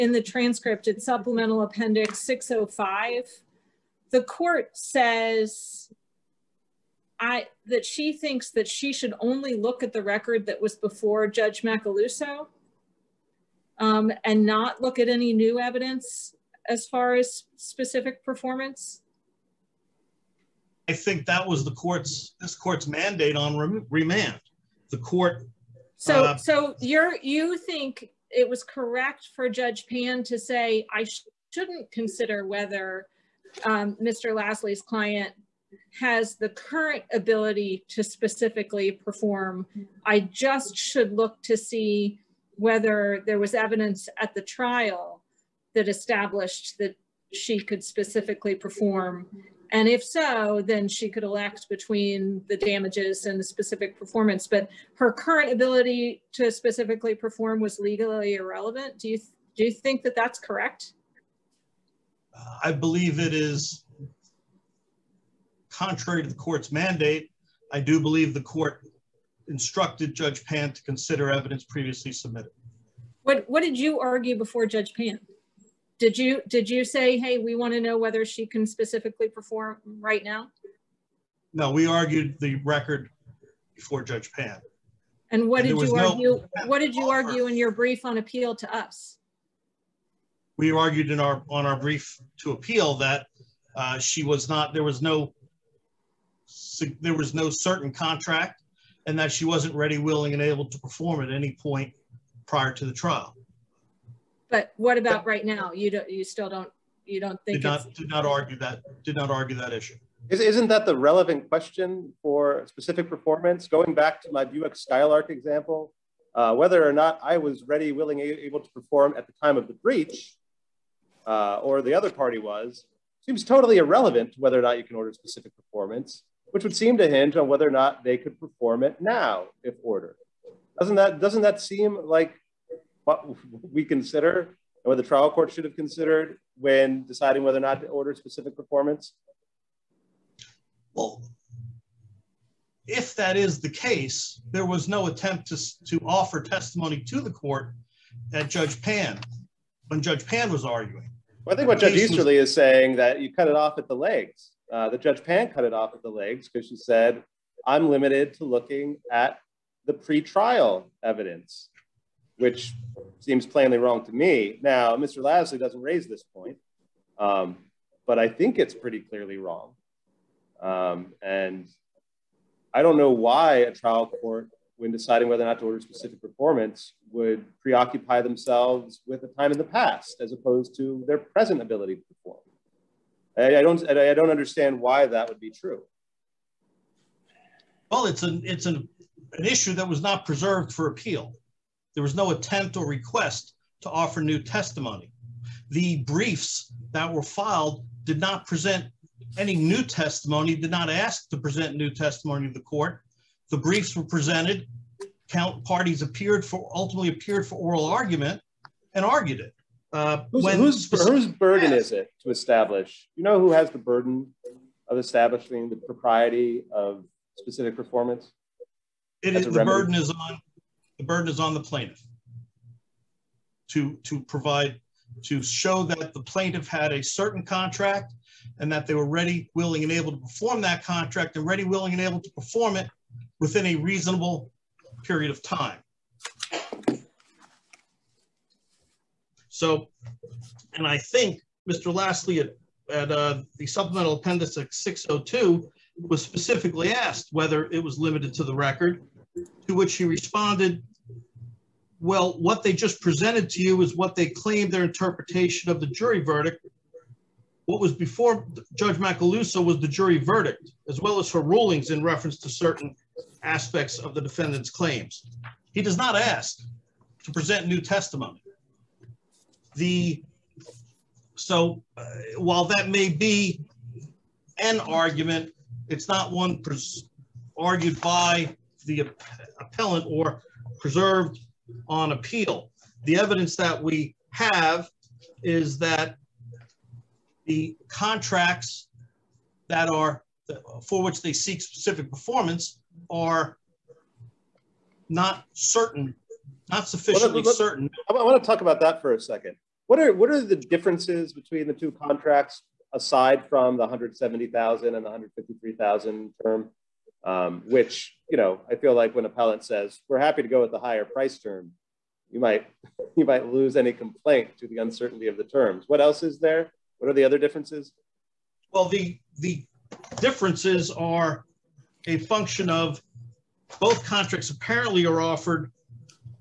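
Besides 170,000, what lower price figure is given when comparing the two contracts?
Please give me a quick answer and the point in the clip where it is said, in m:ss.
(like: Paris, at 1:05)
153,000, at 5:05.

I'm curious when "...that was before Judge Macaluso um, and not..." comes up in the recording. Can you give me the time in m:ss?
0:10.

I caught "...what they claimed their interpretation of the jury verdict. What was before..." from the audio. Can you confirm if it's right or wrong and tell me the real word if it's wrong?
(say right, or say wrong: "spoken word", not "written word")
right.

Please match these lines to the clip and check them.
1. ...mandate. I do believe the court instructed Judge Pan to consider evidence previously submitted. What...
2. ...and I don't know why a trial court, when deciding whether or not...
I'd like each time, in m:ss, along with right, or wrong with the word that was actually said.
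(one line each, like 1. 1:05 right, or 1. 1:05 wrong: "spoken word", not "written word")
1. 1:06 right
2. 2:51 right.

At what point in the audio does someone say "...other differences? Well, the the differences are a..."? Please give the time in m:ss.
5:17.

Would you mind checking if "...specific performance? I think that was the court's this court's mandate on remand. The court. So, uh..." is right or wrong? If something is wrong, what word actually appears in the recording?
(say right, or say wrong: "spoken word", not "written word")
right.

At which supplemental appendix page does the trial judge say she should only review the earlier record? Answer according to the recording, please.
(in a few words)
605.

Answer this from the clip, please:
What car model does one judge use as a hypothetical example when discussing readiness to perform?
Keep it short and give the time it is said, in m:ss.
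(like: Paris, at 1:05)
Buick Skylark, at 1:54.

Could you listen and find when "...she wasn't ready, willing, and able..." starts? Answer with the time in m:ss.
1:39.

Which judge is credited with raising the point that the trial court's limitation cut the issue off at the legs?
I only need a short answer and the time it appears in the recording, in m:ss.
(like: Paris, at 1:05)
Judge Easterly, at 2:31.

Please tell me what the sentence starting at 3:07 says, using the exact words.
Well, it's an it's an an issue that was not preserved for appeal.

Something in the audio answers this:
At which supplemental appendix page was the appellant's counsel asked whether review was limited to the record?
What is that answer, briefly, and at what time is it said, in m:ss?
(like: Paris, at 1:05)
602, at 4:04.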